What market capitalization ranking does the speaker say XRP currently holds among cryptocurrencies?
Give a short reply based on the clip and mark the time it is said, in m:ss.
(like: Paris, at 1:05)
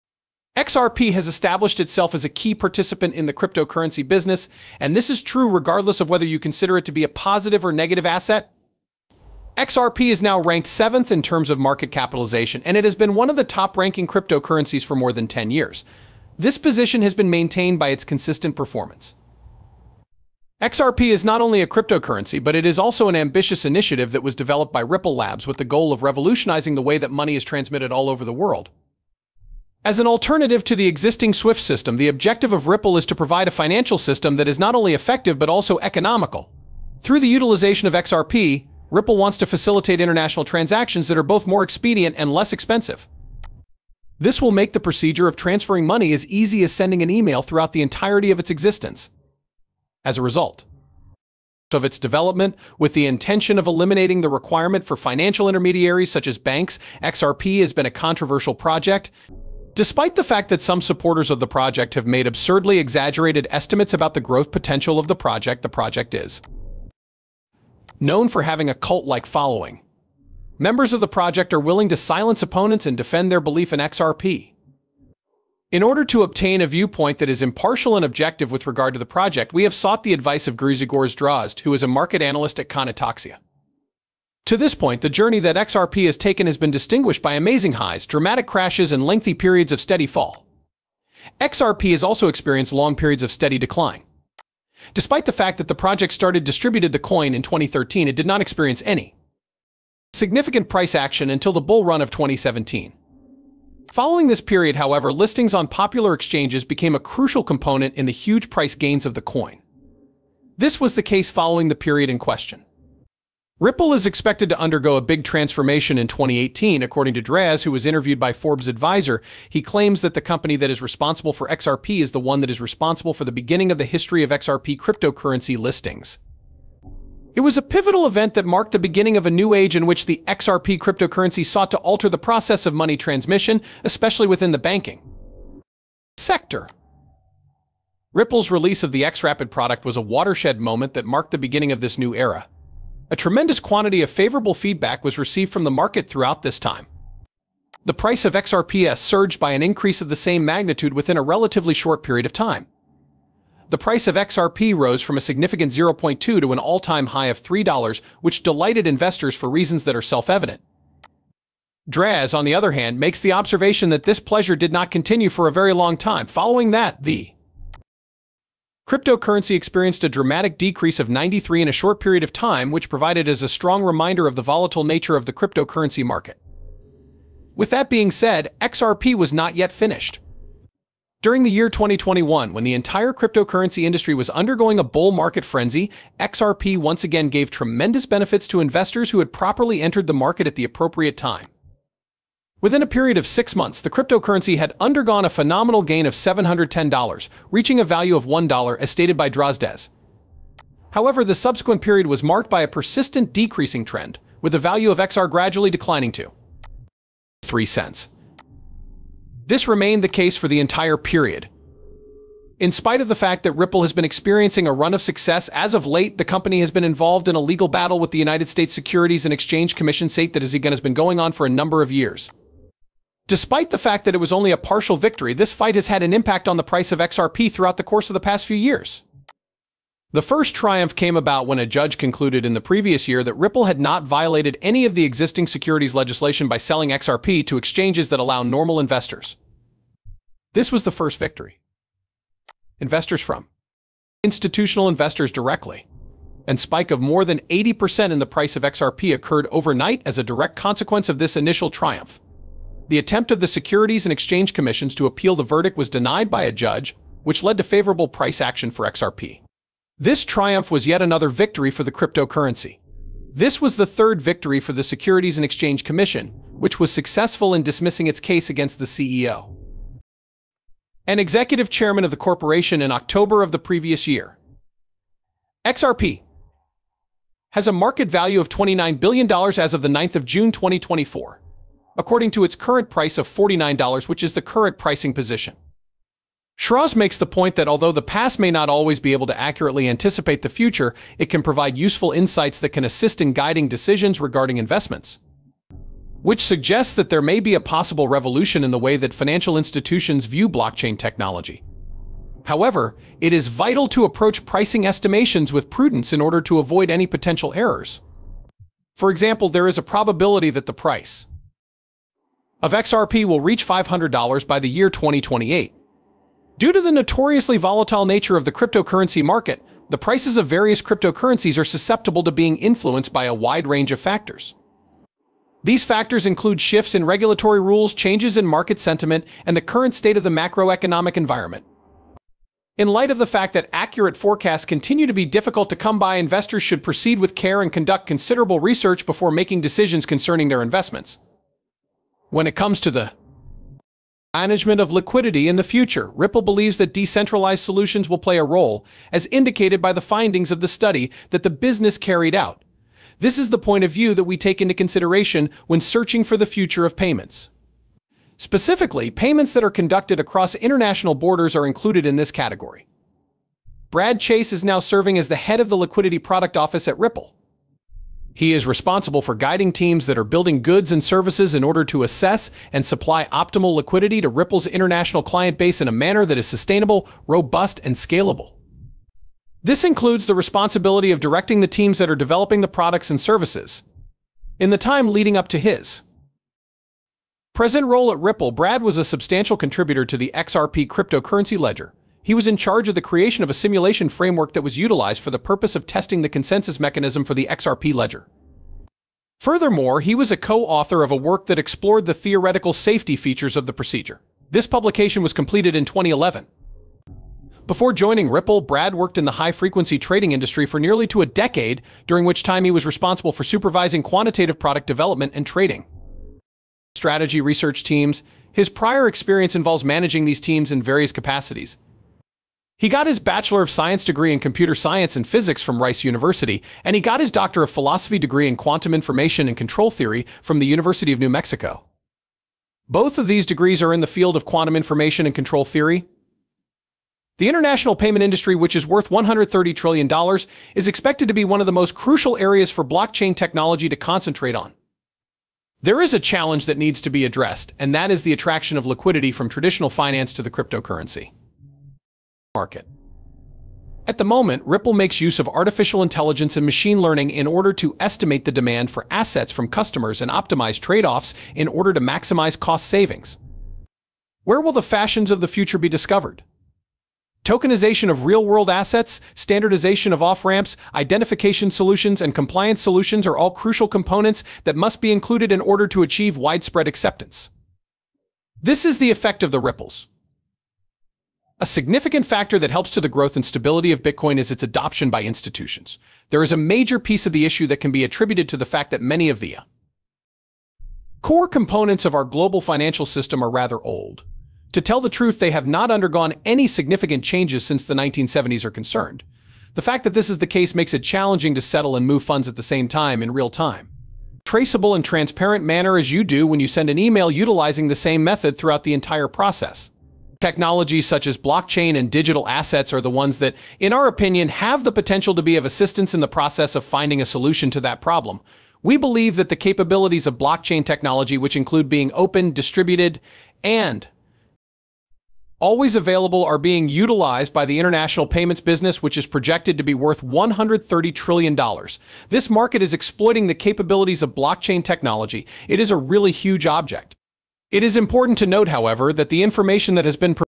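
7th, at 0:10.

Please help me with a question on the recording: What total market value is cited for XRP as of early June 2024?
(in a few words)
$29 billion.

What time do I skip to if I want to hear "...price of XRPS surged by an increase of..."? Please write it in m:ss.
2:27.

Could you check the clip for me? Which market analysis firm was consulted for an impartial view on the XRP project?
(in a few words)
Conotoxia.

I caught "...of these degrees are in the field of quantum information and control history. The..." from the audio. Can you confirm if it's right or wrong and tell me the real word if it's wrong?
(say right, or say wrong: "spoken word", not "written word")
wrong: "theory", not "history".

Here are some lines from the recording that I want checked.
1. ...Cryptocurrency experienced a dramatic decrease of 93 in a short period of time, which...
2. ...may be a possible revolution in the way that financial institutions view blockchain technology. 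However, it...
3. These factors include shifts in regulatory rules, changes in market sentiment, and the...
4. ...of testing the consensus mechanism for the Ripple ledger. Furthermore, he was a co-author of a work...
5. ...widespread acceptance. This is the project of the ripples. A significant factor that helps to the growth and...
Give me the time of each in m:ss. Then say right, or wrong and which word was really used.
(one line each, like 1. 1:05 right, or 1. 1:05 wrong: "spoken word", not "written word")
1. 2:48 right
2. 4:57 right
3. 5:25 right
4. 6:35 wrong: "XRP", not "Ripple"
5. 7:56 wrong: "effect", not "project".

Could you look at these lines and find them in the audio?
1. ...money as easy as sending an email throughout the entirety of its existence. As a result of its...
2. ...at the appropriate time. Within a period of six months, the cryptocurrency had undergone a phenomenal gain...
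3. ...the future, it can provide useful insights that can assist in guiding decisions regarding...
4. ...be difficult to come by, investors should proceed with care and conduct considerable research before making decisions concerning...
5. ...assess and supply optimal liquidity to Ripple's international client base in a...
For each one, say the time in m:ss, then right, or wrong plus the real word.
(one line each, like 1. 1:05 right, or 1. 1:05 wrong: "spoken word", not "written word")
1. 0:45 right
2. 3:10 right
3. 4:50 right
4. 5:35 right
5. 6:12 right.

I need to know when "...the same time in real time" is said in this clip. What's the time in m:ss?
8:22.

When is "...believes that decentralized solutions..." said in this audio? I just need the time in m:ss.
5:46.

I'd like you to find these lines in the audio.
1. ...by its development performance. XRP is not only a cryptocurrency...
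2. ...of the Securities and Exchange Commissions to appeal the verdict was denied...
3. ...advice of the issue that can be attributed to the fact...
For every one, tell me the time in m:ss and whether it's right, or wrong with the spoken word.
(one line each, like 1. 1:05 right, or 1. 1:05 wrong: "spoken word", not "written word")
1. 0:17 wrong: "consistent", not "development"
2. 4:13 right
3. 8:06 wrong: "piece", not "advice".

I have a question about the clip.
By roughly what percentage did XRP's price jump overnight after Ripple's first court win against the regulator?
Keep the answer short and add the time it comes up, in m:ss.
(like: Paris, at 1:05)
more than 80%, at 4:06.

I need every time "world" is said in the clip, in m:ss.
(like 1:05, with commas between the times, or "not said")
0:28, 7:48.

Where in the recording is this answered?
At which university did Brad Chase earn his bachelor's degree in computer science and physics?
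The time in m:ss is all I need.
7:05.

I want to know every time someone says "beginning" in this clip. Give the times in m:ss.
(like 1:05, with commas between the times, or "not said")
2:03, 2:08, 2:21.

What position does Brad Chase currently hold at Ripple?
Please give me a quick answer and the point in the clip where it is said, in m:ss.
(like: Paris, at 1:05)
head of the Liquidity Product Office, at 6:05.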